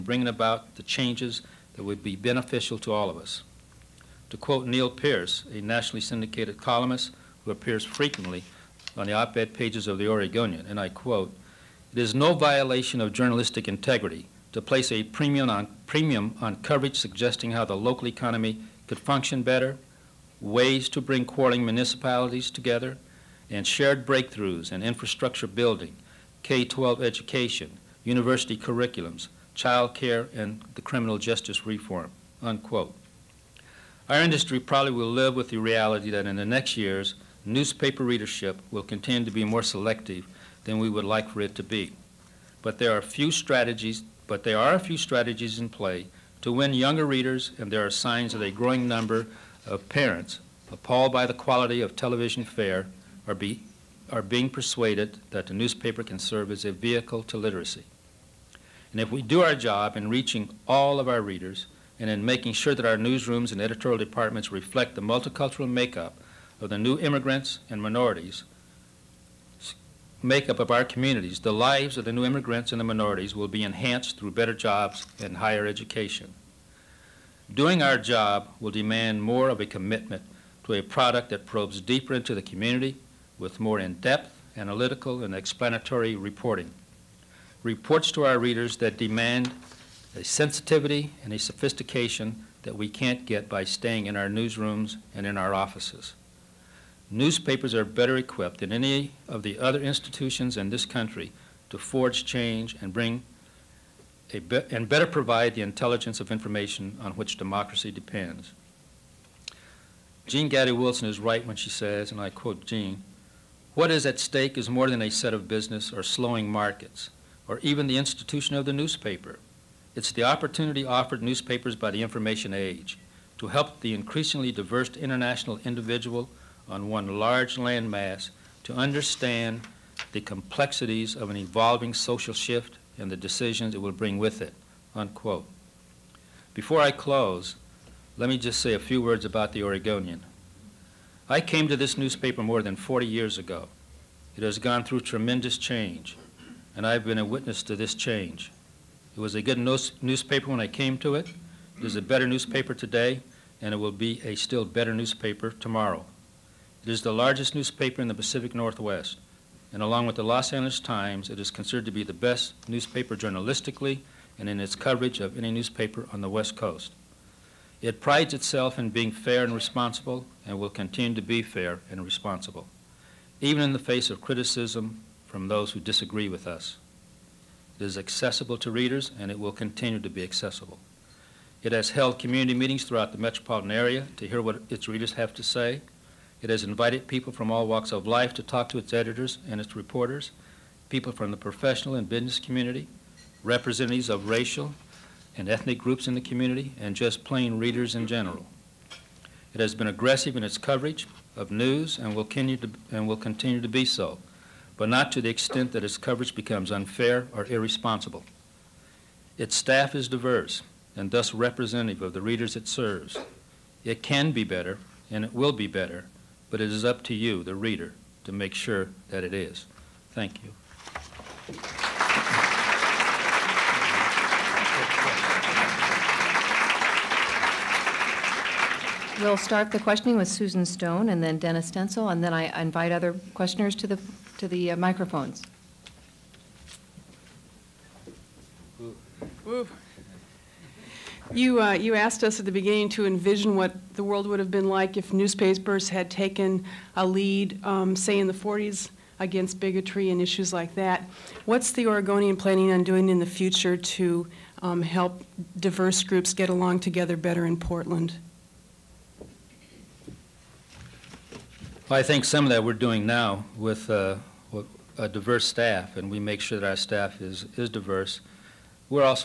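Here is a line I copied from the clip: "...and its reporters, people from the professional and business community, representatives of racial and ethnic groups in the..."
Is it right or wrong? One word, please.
right.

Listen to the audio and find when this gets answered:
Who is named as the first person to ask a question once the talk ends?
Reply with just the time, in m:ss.
3:50.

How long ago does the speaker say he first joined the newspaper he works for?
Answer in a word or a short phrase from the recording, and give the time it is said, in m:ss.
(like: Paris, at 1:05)
more than 40 years, at 2:22.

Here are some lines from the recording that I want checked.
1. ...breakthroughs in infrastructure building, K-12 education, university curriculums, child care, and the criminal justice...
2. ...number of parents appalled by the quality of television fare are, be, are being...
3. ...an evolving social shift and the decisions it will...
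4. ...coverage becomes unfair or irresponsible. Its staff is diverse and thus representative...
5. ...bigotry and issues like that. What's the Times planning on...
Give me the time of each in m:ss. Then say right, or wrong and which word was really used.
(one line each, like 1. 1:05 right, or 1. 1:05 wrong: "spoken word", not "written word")
1. 0:24 right
2. 0:48 right
3. 2:11 right
4. 3:25 right
5. 4:09 wrong: "Oregonian", not "Times".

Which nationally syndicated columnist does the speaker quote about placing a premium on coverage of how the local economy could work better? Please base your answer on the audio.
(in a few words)
Neal Peirce.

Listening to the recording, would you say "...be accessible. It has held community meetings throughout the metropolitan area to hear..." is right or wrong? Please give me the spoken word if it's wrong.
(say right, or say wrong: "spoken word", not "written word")
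right.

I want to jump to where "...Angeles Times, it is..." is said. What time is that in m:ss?
2:40.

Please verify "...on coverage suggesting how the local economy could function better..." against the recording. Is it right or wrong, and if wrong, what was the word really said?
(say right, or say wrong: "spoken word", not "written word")
right.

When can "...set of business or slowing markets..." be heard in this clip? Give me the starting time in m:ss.
1:55.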